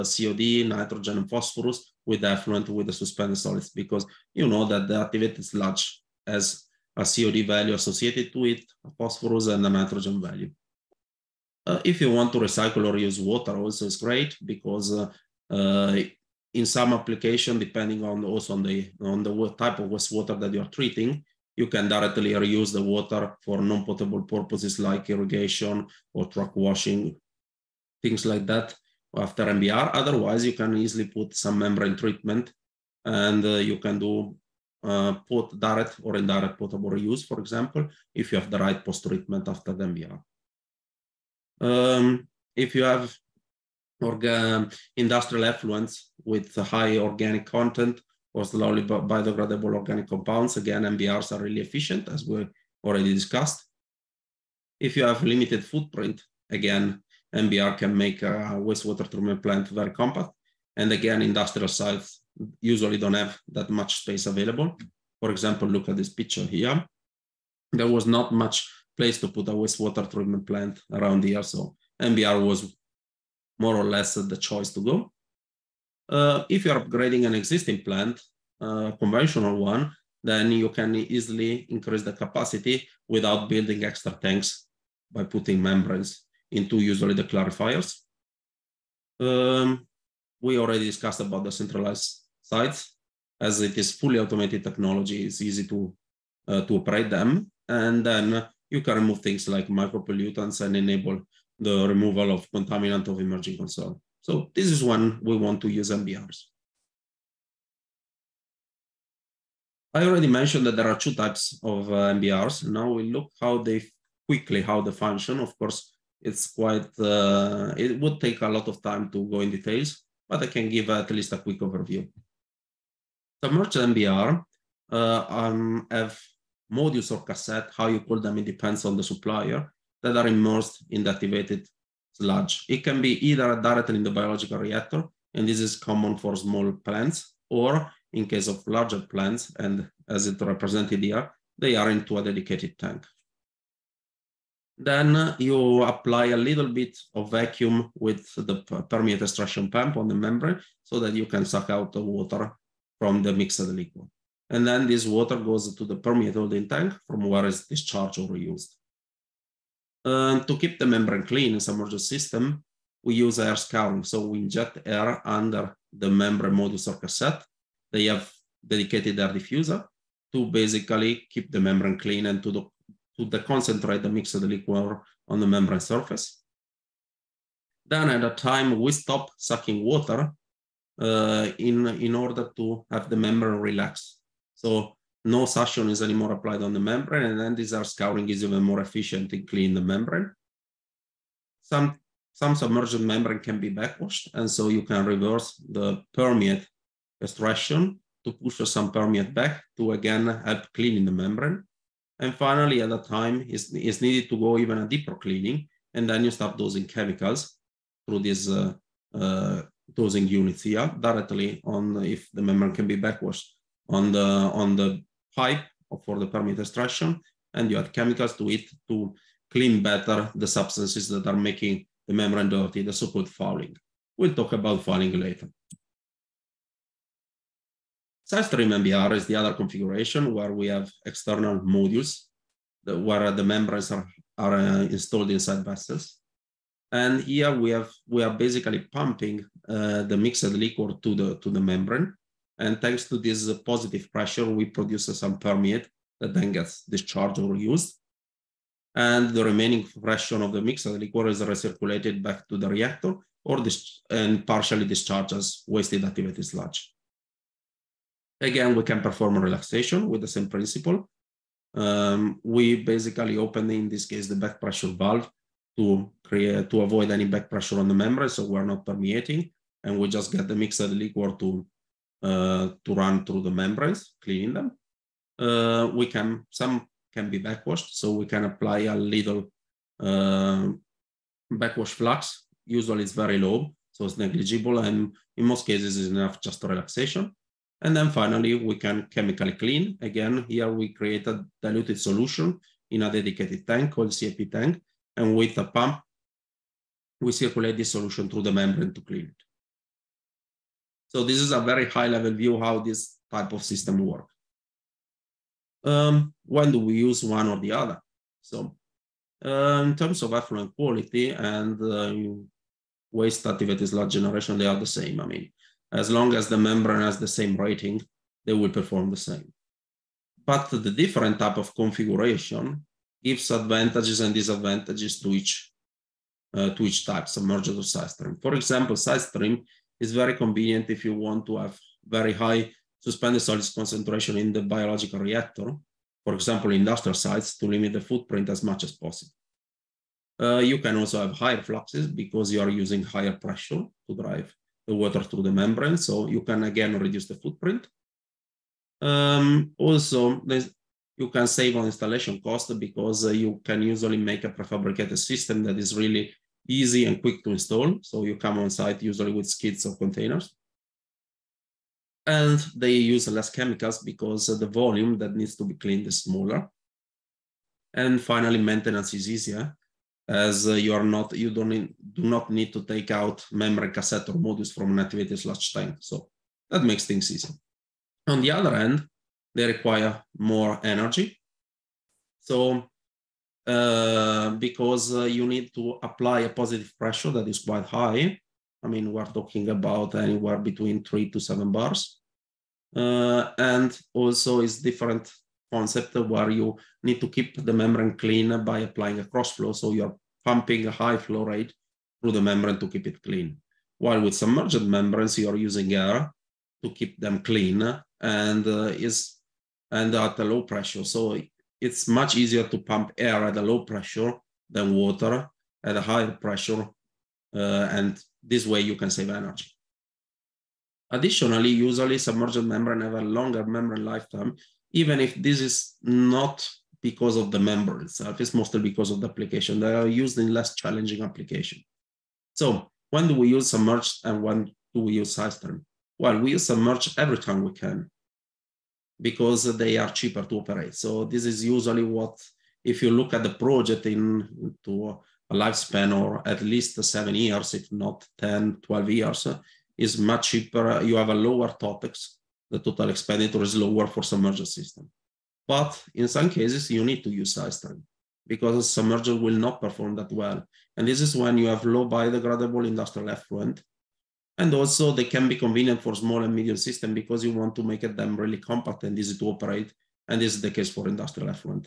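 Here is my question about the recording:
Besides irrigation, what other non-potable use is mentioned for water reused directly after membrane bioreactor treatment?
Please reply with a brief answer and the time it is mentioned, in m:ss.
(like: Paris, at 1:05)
Truck washing, at 0:26.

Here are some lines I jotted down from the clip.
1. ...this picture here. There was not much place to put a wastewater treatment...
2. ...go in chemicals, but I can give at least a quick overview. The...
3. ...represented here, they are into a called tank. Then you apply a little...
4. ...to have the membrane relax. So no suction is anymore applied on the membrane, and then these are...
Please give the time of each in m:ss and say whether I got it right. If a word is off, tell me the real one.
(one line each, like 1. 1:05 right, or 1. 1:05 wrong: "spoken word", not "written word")
1. 1:05 right
2. 1:59 wrong: "details", not "chemicals"
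3. 2:20 wrong: "dedicated", not "called"
4. 3:02 right.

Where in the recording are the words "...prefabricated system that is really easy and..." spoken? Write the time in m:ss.
5:54.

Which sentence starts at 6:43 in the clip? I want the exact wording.
While with submerged membranes, you're using air to keep them clean and uh, is and at a low pressure.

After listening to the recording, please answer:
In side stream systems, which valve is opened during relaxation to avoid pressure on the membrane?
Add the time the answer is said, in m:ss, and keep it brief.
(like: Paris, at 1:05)
Back pressure valve, at 4:24.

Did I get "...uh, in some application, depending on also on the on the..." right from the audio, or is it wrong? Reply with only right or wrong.
right.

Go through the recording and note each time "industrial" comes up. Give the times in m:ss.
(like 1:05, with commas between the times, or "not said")
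0:44, 1:01, 5:36, 7:42, 7:51.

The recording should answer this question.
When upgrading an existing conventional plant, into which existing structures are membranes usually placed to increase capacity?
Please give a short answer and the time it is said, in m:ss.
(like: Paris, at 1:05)
The clarifiers, at 1:27.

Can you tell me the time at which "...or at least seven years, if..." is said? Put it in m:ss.
7:26.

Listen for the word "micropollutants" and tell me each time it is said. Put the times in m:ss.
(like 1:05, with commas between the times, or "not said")
1:39.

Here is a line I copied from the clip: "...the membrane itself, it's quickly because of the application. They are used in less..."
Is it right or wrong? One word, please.
wrong.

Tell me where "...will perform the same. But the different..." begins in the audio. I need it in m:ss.
5:18.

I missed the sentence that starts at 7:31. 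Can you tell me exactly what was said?
You have a lower totex, The total expenditure is lower for submerged system.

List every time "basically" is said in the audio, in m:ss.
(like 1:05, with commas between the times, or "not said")
2:50, 3:58, 4:22.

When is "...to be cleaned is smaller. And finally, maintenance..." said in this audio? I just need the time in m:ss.
6:05.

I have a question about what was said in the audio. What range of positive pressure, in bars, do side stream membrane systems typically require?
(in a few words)
3 to 7 bars.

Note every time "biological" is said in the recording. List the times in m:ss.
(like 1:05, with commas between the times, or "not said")
2:14, 5:34.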